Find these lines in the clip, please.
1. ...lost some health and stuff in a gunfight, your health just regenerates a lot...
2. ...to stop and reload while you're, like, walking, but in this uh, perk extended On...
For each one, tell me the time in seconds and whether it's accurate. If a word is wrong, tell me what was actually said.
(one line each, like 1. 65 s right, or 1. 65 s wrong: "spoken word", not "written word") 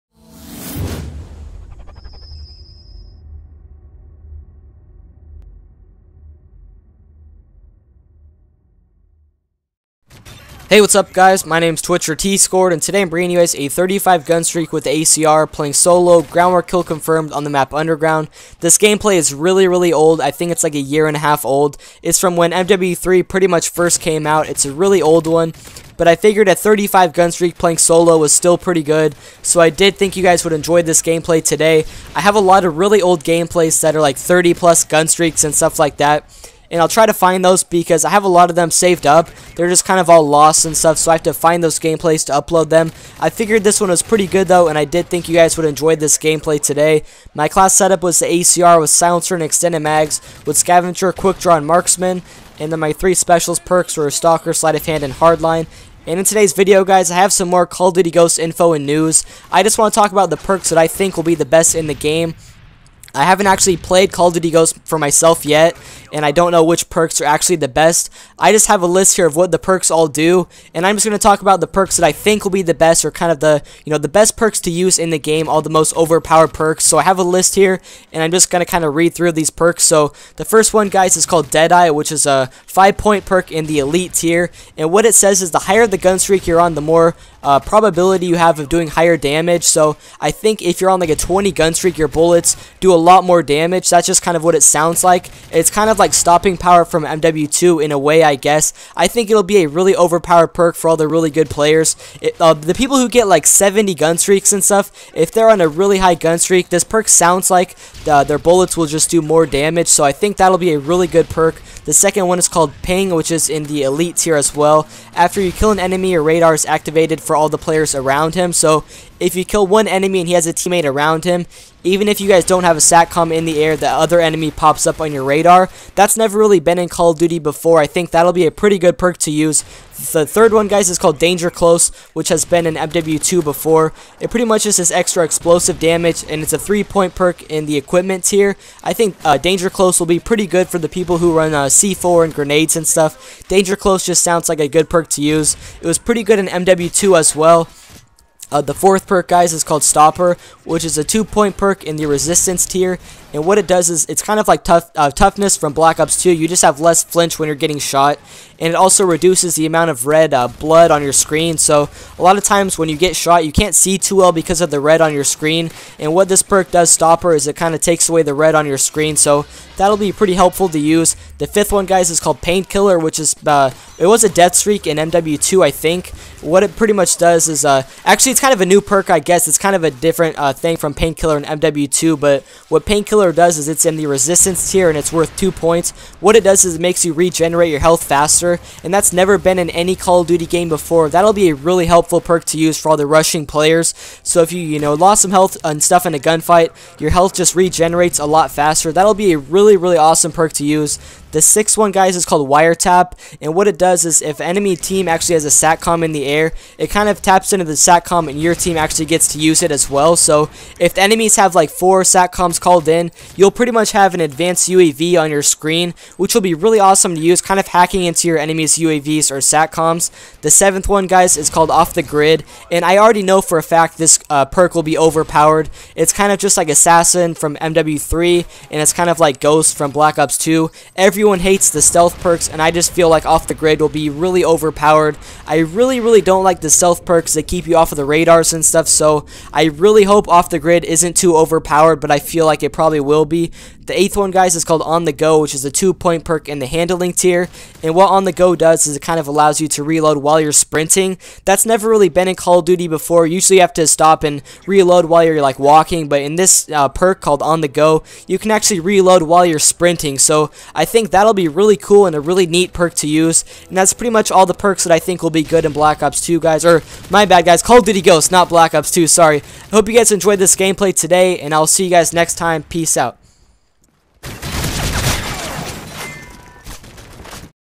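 1. 194 s right
2. 253 s wrong: "called", not "extended".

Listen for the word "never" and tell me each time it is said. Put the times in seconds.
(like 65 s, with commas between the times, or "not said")
126 s, 189 s, 251 s.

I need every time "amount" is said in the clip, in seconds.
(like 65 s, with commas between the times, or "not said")
159 s.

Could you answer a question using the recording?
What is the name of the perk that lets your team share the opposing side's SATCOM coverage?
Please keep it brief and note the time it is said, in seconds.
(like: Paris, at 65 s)
Wiretap, at 202 s.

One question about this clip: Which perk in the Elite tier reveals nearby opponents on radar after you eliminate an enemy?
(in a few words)
Ping.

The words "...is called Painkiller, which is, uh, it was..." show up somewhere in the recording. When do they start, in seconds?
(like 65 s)
172 s.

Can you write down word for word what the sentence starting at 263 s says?
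And that's pretty much all the perks that I think will be good in Black Ops 2, guys.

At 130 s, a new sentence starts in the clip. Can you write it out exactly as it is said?
The third one, guys, is called Danger Close, which has been in MW2 before.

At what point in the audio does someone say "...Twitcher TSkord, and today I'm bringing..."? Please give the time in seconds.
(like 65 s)
11 s.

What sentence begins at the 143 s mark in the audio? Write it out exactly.
Danger Close just sounds like a good perk to use.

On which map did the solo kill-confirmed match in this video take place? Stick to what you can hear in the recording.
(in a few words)
Underground.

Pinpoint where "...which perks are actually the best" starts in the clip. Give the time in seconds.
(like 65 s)
66 s.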